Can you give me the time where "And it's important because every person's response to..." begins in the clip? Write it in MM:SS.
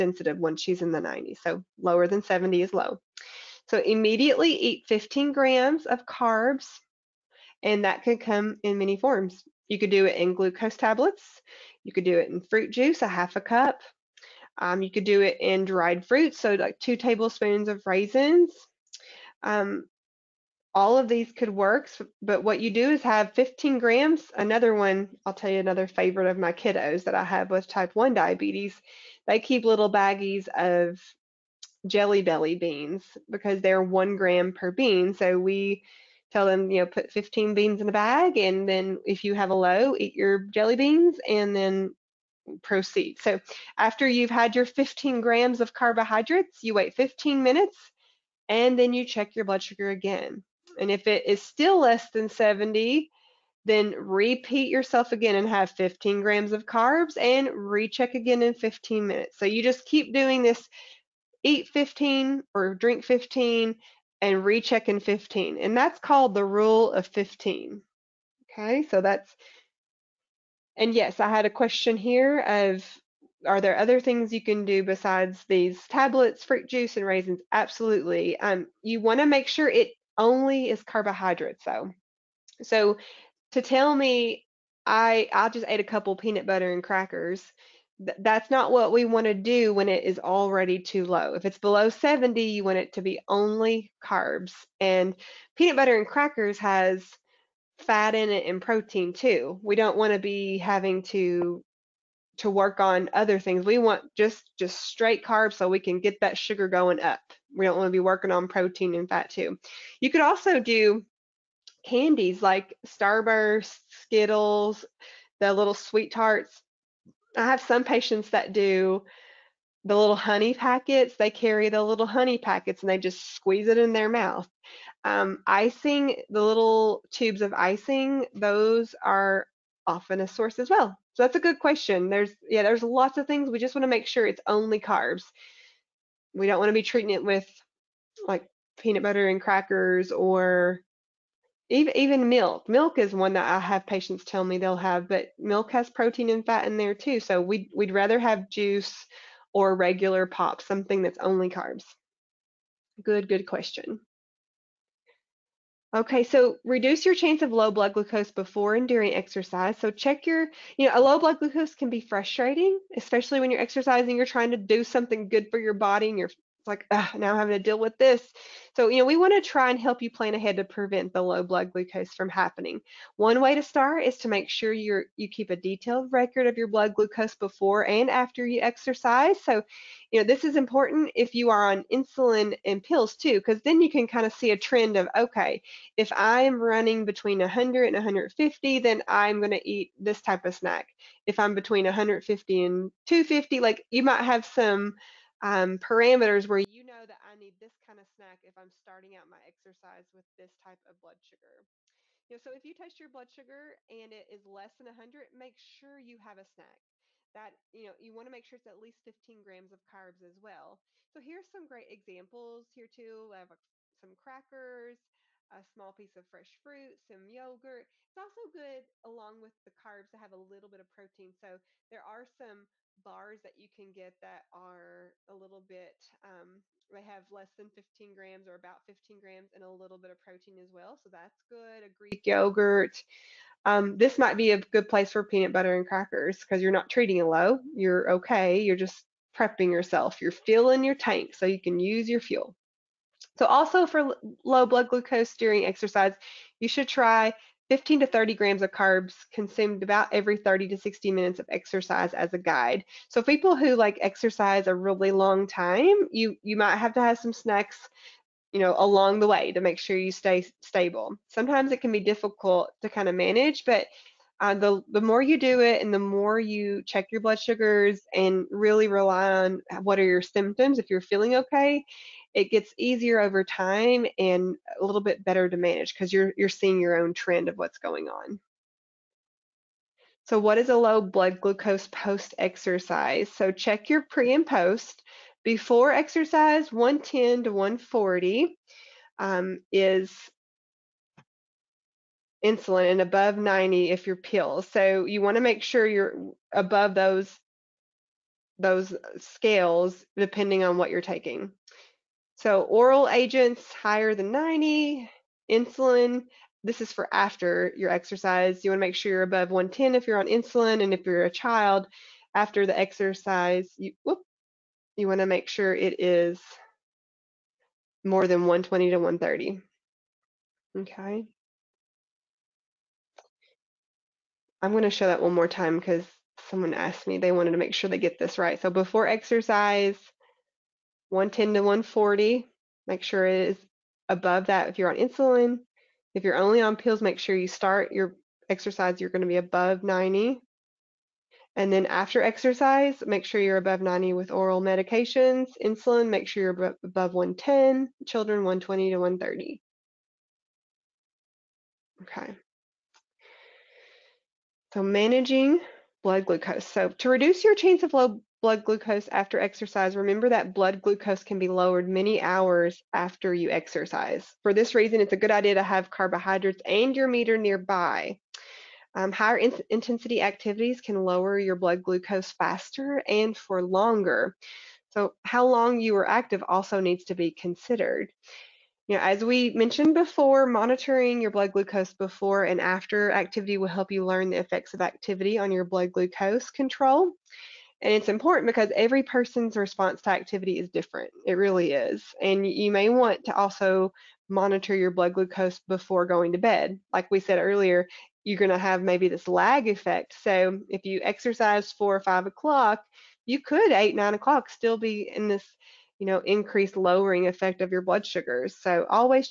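06:27.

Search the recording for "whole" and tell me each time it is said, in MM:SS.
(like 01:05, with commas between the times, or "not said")
not said.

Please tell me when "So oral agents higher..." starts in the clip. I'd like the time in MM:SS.
05:02.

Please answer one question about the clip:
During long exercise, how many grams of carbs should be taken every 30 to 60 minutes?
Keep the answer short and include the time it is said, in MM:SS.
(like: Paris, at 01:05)
15 to 30 grams, at 04:07.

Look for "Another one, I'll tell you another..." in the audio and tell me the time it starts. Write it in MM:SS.
00:24.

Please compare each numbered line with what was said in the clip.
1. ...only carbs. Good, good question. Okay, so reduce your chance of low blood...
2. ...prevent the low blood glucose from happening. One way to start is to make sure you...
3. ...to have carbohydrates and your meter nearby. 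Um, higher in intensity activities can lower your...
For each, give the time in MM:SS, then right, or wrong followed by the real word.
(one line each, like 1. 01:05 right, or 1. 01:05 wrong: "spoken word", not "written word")
1. 02:31 right
2. 02:50 right
3. 06:05 right.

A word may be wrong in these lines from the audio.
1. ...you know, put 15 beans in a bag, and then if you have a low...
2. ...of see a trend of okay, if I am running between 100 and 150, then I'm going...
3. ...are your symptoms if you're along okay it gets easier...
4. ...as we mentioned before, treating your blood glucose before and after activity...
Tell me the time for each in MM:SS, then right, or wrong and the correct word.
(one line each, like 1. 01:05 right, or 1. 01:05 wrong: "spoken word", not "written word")
1. 00:36 right
2. 03:04 right
3. 04:29 wrong: "feeling", not "along"
4. 06:19 wrong: "monitoring", not "treating".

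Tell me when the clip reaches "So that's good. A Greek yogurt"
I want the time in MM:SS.
03:50.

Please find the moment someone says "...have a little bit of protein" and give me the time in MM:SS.
03:40.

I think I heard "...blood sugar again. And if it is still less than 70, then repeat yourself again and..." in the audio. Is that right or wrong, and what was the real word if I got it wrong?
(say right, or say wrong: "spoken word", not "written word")
right.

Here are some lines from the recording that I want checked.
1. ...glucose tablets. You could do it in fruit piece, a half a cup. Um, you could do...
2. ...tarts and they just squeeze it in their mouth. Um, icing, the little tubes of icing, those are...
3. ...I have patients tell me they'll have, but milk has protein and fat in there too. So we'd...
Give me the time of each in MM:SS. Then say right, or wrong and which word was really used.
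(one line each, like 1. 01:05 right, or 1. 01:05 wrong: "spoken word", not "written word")
1. 00:10 wrong: "juice", not "piece"
2. 02:02 wrong: "packets", not "tarts"
3. 02:23 right.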